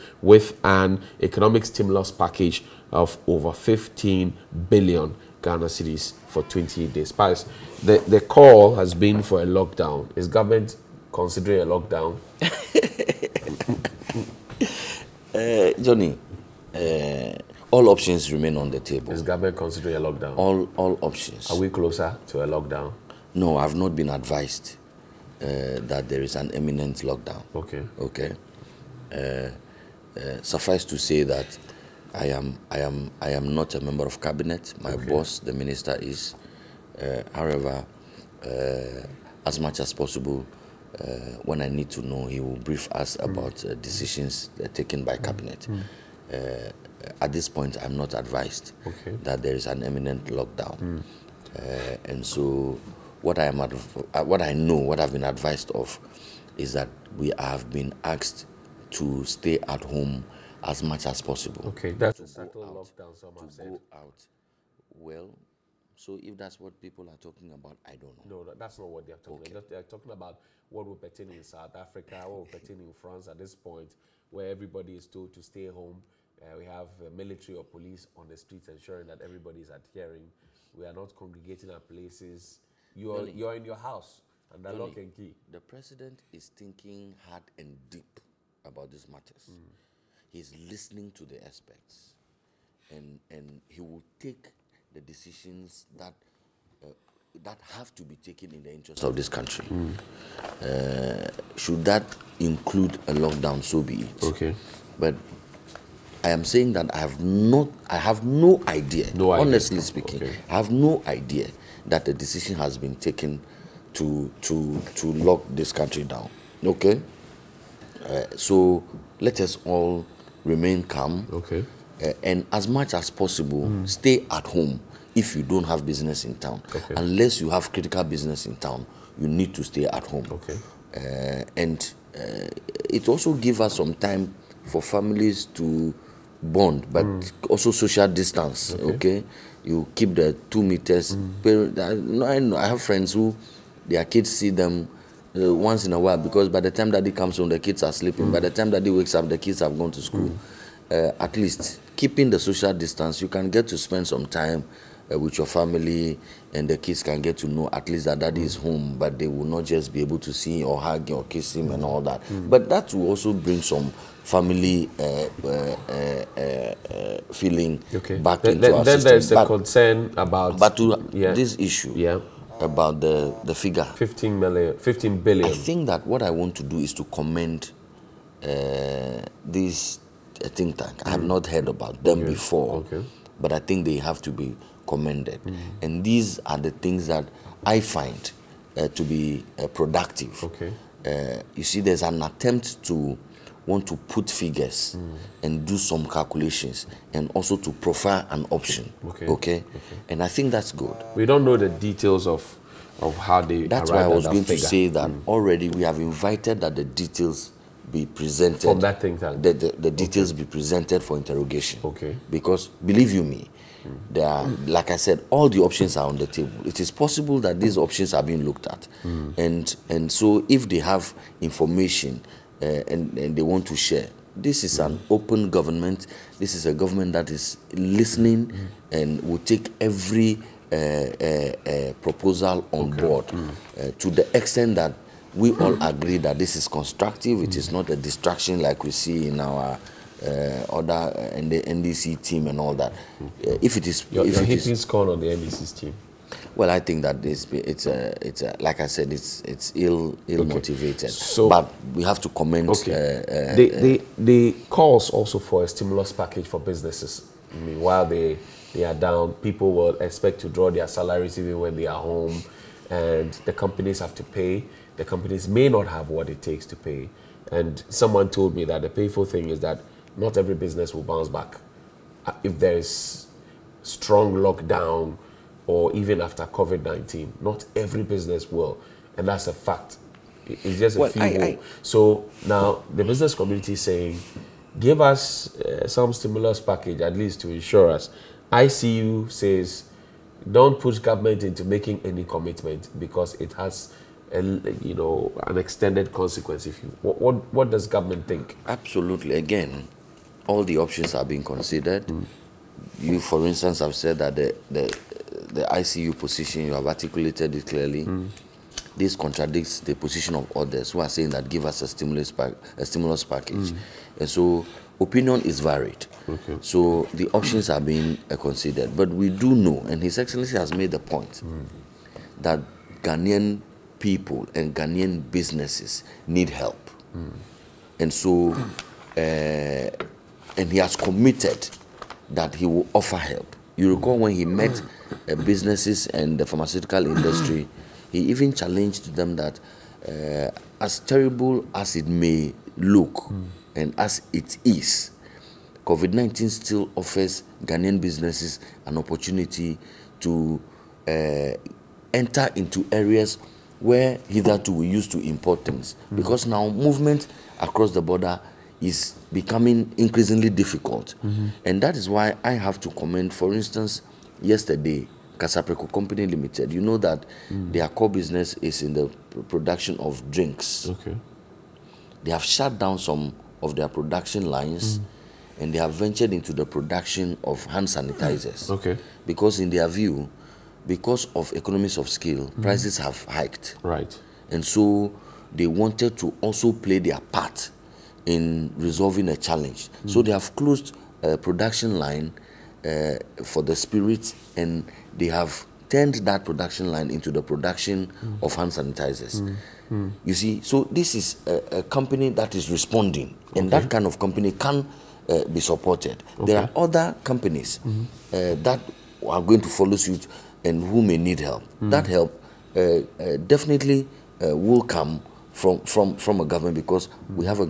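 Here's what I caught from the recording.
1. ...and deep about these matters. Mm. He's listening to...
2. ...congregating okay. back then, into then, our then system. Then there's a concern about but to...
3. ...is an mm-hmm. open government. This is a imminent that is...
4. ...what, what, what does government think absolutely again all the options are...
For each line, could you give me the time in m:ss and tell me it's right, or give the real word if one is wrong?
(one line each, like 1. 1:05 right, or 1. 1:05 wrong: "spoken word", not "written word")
1. 1:27 right
2. 2:47 wrong: "feeling", not "congregating"
3. 3:44 wrong: "government", not "imminent"
4. 4:57 right.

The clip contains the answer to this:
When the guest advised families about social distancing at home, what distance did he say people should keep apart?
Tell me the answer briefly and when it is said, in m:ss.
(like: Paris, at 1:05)
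2 meters, at 2:20.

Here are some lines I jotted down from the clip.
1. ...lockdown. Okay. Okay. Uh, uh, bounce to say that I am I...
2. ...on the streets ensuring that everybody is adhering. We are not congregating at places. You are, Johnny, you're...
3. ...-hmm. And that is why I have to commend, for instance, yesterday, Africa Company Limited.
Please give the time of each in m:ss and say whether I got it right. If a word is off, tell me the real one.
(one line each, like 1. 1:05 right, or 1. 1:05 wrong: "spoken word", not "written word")
1. 0:27 wrong: "suffice", not "bounce"
2. 1:18 right
3. 6:01 wrong: "Kasapreko", not "Africa".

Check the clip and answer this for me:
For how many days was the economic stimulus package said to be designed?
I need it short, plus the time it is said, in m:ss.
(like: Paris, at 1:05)
28, at 0:06.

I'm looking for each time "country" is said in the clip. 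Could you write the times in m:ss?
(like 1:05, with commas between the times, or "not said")
1:39, 1:55.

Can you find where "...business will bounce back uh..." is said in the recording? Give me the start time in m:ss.
4:30.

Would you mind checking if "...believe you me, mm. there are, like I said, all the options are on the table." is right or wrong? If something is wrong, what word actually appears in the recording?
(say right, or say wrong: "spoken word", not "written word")
right.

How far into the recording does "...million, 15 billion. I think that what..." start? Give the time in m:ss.
2:54.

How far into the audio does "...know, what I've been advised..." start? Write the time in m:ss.
0:54.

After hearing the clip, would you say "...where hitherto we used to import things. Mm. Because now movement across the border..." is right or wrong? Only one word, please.
right.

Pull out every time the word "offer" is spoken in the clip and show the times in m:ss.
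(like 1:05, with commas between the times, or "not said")
5:32, 5:46.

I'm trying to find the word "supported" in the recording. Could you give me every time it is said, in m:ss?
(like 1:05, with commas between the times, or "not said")
6:45.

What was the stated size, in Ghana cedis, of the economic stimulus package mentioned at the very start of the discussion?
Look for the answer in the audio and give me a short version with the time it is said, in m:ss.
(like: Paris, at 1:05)
over 15 billion Ghana cedis, at 0:03.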